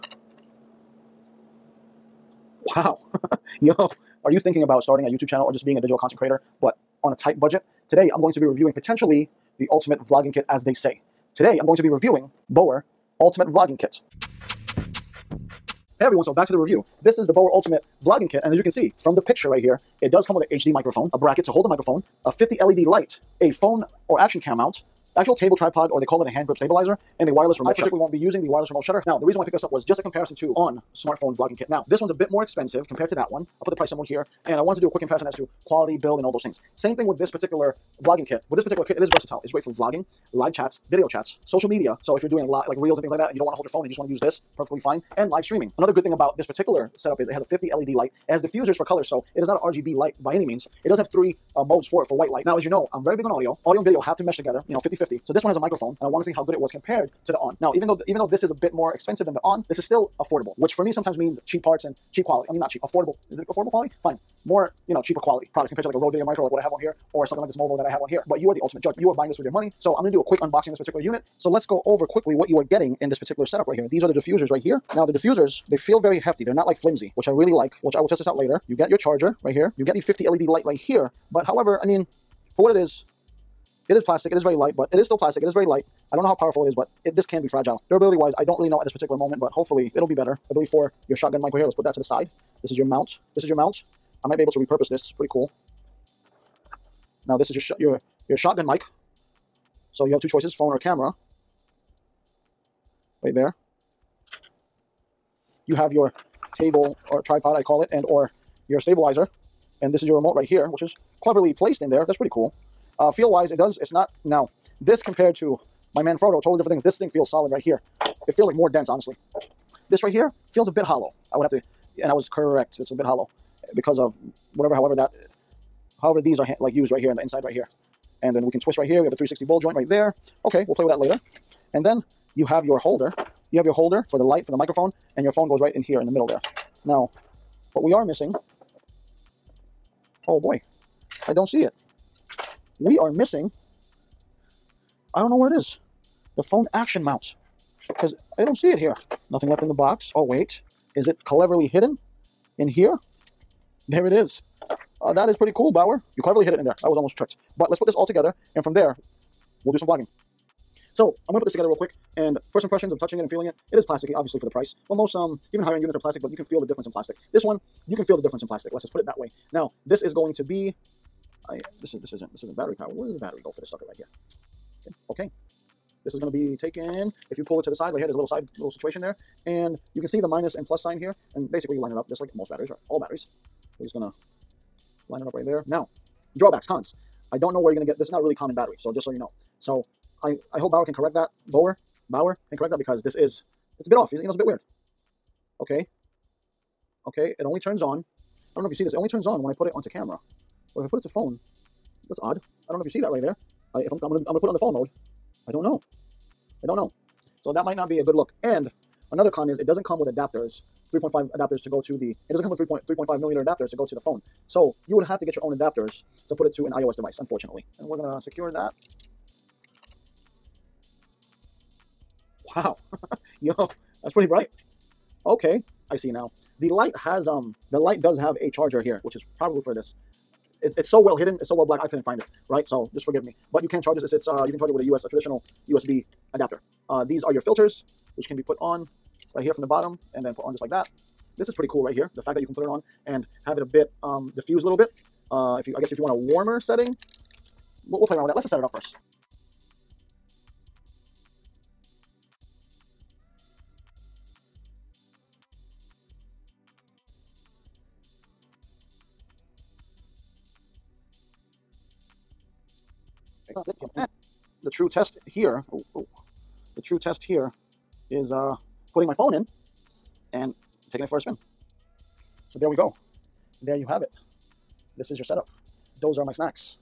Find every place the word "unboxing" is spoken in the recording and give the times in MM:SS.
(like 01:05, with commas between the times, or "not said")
01:10.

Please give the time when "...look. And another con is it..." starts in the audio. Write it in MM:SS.
03:28.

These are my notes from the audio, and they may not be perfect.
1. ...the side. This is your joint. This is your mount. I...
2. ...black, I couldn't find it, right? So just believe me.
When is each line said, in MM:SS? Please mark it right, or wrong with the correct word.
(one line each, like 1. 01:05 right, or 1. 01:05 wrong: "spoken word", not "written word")
1. 01:31 wrong: "mount", not "joint"
2. 03:51 wrong: "forgive", not "believe".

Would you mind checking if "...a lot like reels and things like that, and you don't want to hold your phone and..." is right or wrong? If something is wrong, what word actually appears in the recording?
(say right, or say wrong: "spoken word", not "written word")
right.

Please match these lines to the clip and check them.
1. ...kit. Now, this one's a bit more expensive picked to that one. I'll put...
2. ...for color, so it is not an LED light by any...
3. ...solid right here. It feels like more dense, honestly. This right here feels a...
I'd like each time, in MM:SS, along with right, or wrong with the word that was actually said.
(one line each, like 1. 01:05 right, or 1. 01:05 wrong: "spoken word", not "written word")
1. 00:31 wrong: "compared", not "picked"
2. 00:48 wrong: "RGB", not "LED"
3. 01:57 right.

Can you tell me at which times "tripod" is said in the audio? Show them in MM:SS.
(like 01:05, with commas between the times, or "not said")
00:25, 01:47.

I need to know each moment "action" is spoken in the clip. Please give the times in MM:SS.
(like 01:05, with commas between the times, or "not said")
00:24, 02:26.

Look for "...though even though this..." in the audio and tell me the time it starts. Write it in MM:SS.
00:57.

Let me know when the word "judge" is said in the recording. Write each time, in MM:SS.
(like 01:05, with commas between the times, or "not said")
01:08.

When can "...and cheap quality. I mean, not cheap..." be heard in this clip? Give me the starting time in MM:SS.
01:01.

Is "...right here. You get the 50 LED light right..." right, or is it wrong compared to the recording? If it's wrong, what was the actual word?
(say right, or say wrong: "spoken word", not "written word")
right.